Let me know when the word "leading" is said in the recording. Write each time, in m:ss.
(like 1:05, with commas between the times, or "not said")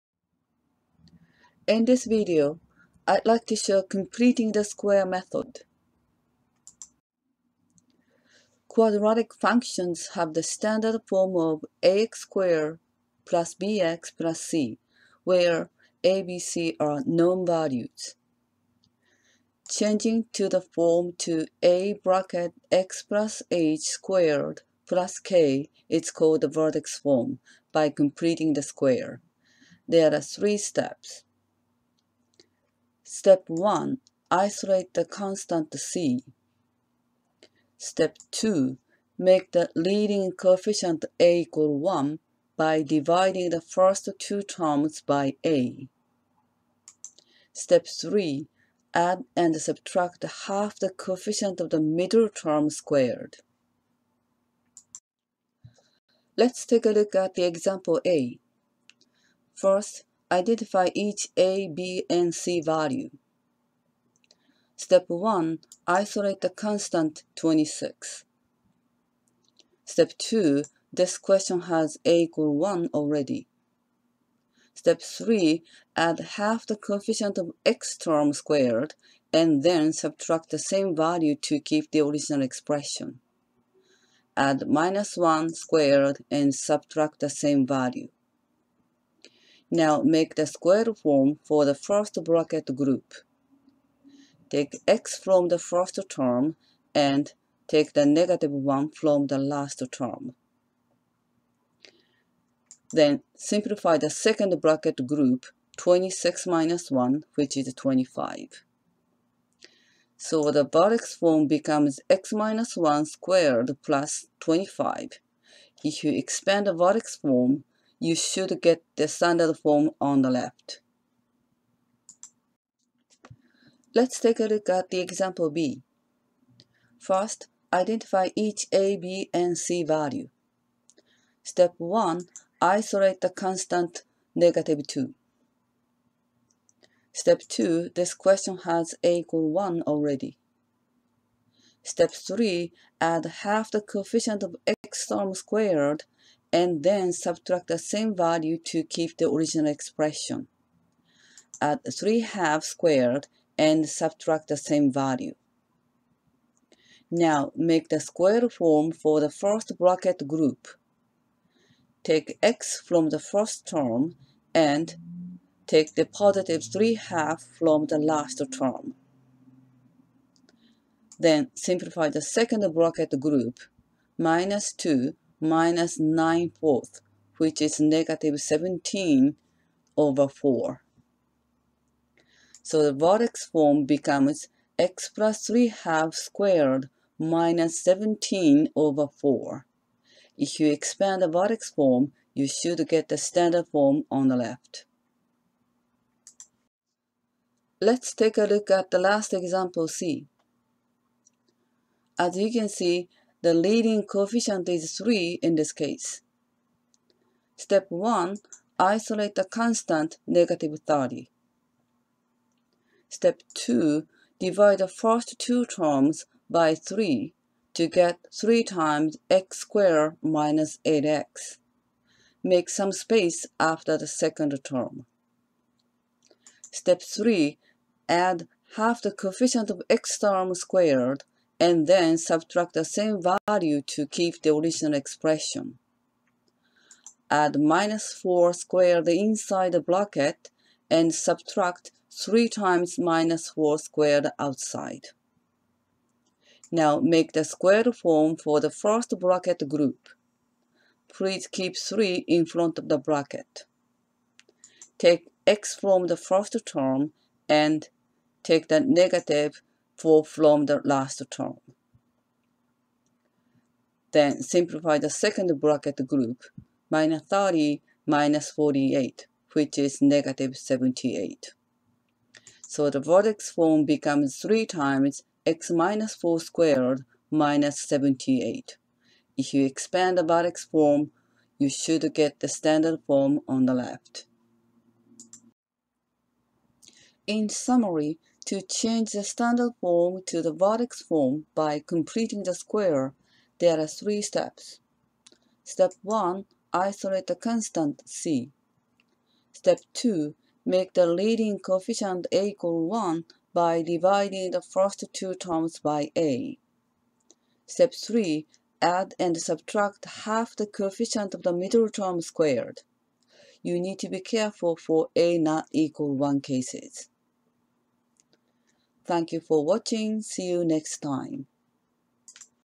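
0:39, 3:23, 5:01.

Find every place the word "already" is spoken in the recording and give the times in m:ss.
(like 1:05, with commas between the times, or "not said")
1:12, 2:19.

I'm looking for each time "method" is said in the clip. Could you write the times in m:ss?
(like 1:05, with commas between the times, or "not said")
0:05.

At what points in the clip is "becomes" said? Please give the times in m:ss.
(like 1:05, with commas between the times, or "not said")
1:51, 3:03, 4:33.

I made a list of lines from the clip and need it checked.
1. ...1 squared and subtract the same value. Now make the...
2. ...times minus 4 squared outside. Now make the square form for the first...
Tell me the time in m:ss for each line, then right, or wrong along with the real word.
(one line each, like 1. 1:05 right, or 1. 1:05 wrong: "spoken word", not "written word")
1. 1:25 right
2. 4:02 right.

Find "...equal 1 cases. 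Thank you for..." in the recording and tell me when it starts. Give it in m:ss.
5:15.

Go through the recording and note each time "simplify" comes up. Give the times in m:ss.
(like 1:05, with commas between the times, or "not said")
1:43, 2:51, 4:24.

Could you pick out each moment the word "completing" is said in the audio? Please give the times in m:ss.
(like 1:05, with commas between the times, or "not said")
0:03, 0:27, 4:51.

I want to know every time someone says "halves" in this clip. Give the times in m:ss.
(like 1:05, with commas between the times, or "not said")
2:32, 2:46.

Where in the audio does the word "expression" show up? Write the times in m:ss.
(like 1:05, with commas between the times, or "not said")
1:22, 2:29, 3:54.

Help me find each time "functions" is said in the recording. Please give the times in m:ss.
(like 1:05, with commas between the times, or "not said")
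0:09.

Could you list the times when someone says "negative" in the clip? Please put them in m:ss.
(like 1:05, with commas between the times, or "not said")
1:38, 2:14, 2:57, 3:30, 4:18, 4:30.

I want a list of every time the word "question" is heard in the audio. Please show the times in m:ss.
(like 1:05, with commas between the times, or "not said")
1:11, 2:18.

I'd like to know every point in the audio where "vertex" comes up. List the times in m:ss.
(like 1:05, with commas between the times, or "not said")
0:26, 1:50, 1:56, 3:02, 3:11, 4:32, 4:40, 4:50.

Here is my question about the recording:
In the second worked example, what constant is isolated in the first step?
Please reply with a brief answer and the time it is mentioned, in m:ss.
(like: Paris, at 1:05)
-2, at 2:14.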